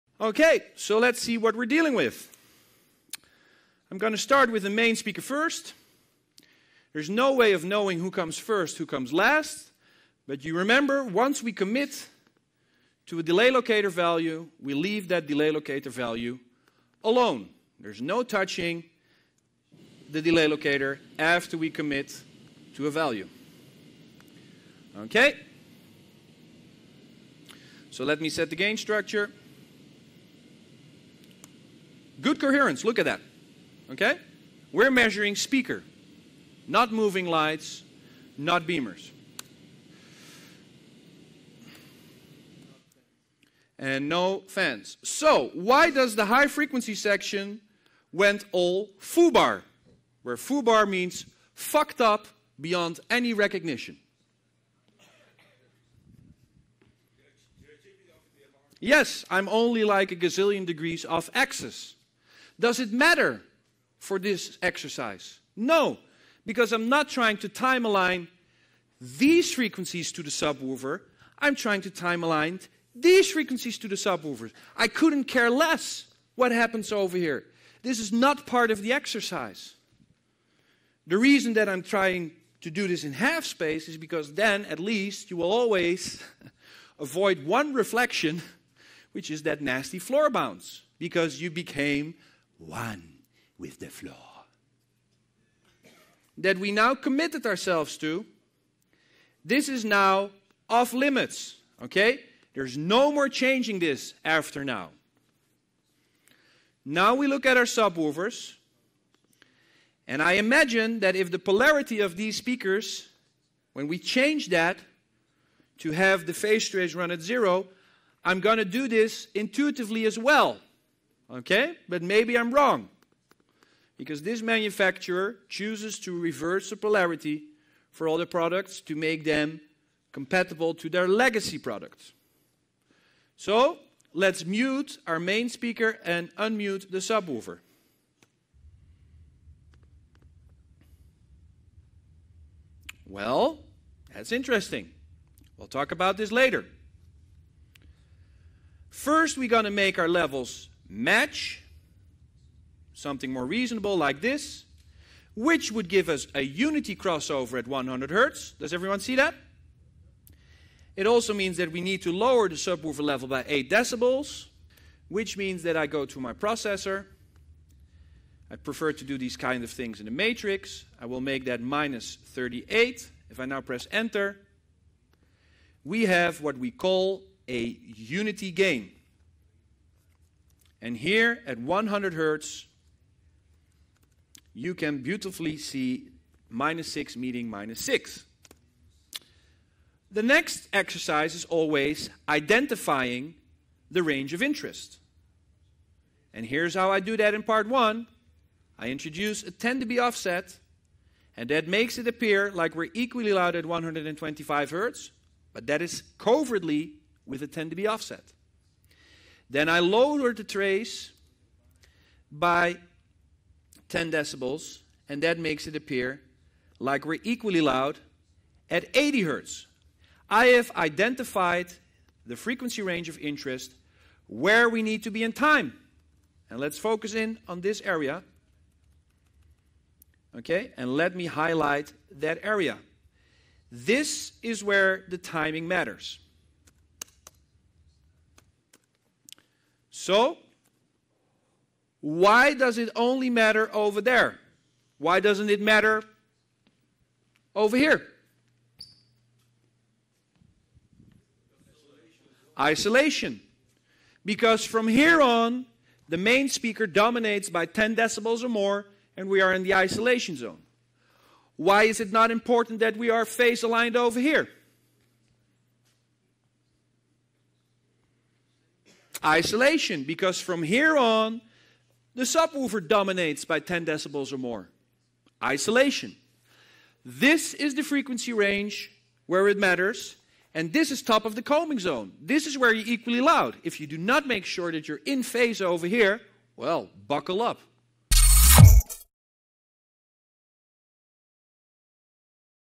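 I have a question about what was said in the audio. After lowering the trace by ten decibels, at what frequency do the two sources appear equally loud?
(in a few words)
80 Hz.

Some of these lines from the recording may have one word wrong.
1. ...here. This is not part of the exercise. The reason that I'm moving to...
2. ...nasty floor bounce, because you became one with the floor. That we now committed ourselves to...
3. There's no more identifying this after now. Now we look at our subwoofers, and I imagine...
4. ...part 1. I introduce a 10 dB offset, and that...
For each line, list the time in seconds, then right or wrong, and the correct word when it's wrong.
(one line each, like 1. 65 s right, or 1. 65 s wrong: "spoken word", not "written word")
1. 77 s wrong: "trying", not "moving"
2. 89 s right
3. 102 s wrong: "changing", not "identifying"
4. 197 s right.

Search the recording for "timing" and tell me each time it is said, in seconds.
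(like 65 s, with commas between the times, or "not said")
235 s.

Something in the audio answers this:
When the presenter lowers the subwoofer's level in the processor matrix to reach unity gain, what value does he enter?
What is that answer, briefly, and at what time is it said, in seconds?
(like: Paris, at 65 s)
-38, at 171 s.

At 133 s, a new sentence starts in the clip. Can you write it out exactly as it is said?
So let's mute our main speaker and unmute the subwoofer.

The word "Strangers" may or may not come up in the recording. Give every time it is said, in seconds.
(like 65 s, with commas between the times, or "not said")
not said.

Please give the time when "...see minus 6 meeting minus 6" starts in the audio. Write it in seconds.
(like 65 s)
185 s.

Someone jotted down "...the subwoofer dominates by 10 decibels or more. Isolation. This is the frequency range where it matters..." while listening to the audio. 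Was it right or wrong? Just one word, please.
right.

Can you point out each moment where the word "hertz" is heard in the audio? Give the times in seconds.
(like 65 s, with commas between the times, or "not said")
158 s, 182 s, 204 s, 219 s.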